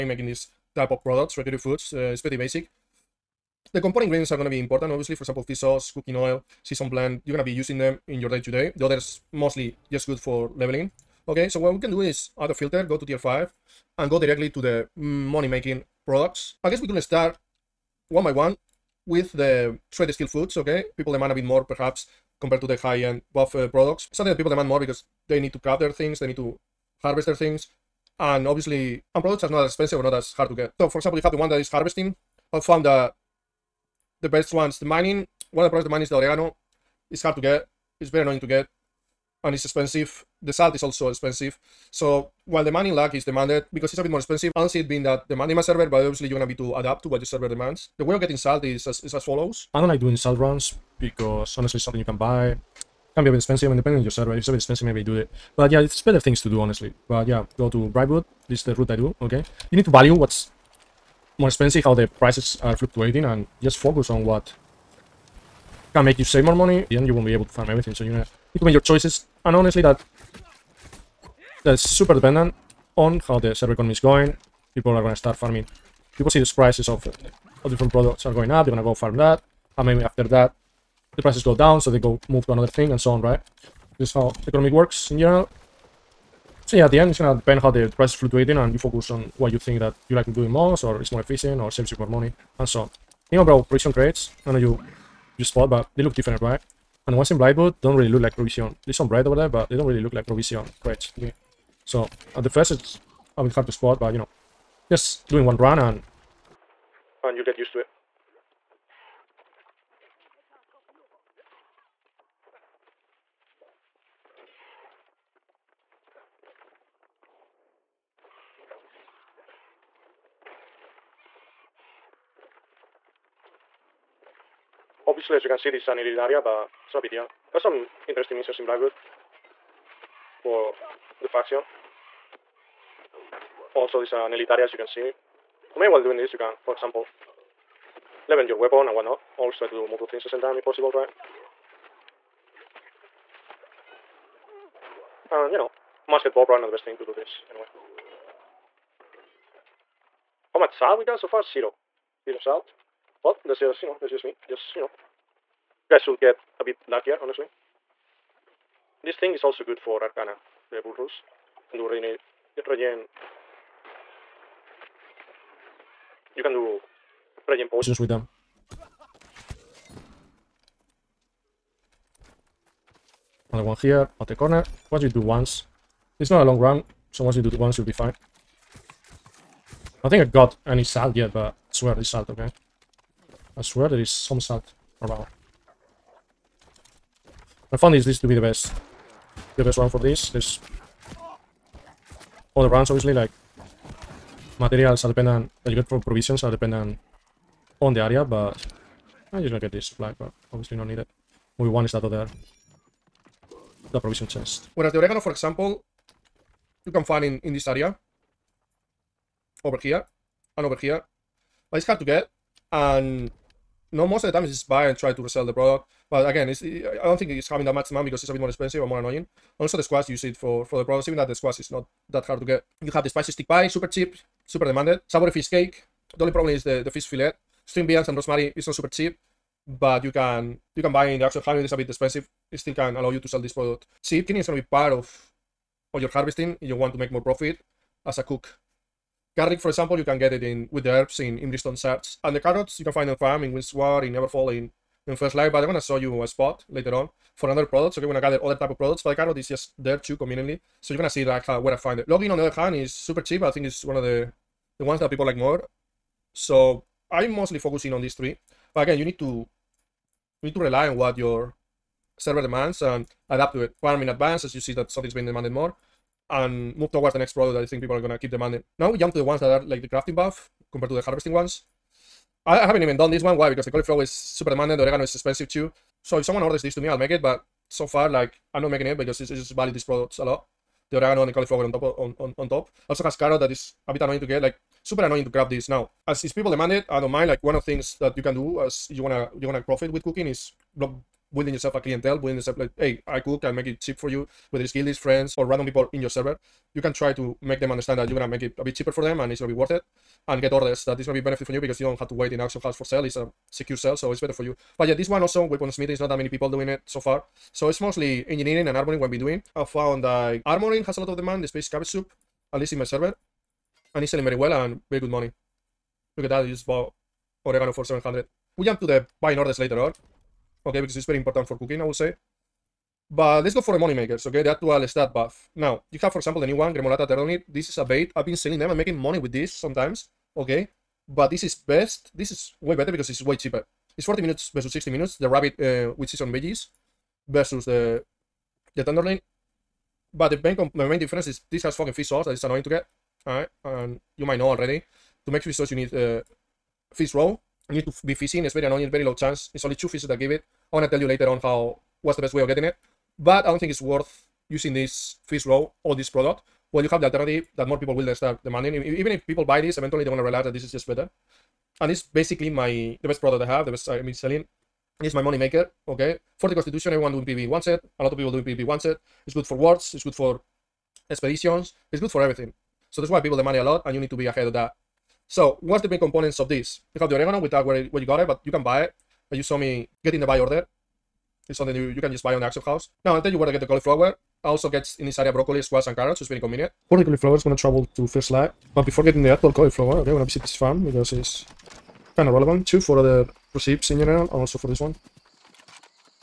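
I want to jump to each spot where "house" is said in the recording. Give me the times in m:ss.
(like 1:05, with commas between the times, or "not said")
3:51, 5:02, 6:22.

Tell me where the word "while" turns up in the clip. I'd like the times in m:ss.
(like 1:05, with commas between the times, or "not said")
0:42, 2:15.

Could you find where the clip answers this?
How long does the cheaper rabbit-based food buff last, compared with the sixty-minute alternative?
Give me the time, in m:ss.
5:34.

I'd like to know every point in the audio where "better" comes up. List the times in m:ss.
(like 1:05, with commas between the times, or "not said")
0:56, 5:04, 5:32, 6:00.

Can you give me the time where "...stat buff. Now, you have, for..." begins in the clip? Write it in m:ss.
5:24.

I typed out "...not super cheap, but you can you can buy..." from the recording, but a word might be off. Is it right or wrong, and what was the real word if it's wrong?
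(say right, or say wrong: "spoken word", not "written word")
right.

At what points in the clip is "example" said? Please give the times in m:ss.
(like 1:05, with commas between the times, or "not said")
0:05, 0:30, 2:16, 3:25, 3:59, 5:26.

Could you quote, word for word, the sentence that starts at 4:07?
Okay, we're gonna gather other type of products, but the carrot is just there too conveniently.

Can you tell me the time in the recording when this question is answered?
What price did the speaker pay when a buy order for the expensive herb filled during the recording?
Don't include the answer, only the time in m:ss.
5:17.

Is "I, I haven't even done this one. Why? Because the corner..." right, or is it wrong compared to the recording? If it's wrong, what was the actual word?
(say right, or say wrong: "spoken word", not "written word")
wrong: "cauliflower", not "corner".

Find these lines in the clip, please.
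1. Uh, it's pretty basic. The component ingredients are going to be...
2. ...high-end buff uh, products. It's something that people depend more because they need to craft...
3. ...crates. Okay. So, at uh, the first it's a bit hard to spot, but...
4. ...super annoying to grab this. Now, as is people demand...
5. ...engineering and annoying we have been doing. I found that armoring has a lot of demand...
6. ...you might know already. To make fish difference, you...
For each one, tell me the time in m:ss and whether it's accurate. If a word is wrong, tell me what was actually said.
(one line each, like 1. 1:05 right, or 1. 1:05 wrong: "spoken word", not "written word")
1. 0:01 right
2. 0:22 wrong: "demand", not "depend"
3. 1:40 right
4. 4:44 right
5. 5:08 wrong: "armoring", not "annoying"
6. 5:44 wrong: "sauce", not "difference".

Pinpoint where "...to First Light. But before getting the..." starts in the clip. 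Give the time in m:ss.
6:27.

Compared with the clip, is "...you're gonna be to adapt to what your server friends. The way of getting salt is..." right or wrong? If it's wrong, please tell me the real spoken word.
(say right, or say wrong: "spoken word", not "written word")
wrong: "demands", not "friends".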